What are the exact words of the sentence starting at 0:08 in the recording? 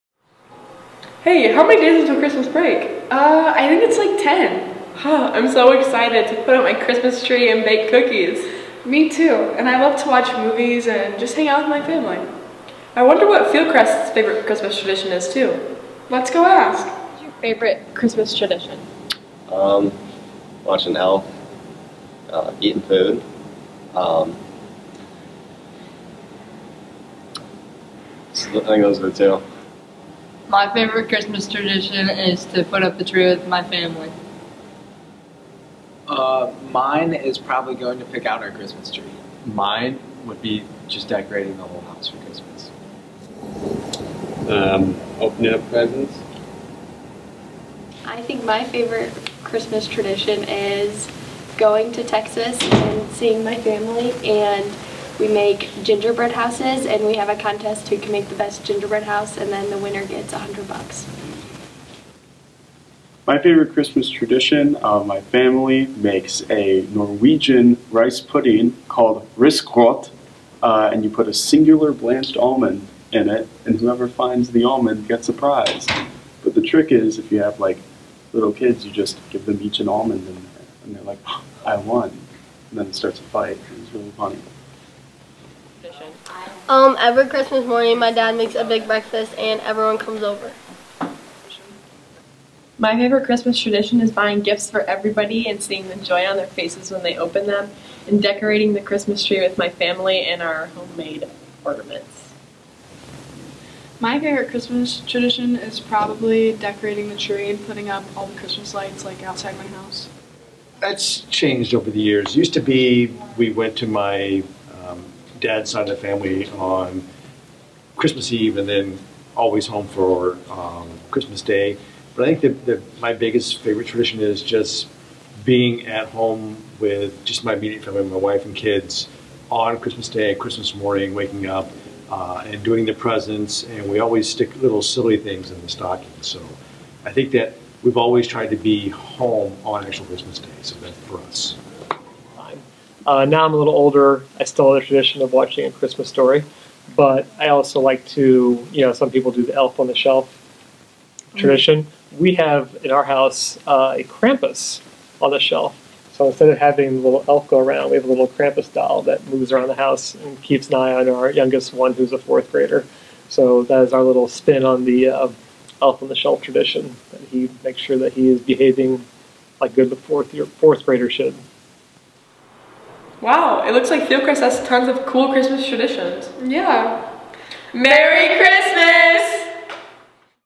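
Me too, and I love to watch movies and just hang out with my family.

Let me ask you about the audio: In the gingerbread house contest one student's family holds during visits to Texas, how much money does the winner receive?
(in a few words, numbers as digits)
$100.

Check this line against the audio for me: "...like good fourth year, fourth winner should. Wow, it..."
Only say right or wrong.
wrong.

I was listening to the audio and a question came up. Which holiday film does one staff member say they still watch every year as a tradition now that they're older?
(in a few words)
A Christmas Story.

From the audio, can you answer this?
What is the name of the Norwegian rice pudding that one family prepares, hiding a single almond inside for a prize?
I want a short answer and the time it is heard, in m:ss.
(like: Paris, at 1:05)
risgrøt, at 1:09.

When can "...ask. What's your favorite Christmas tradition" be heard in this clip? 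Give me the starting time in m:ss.
0:16.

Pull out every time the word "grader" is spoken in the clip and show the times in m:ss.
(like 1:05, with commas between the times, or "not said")
2:42, 2:50.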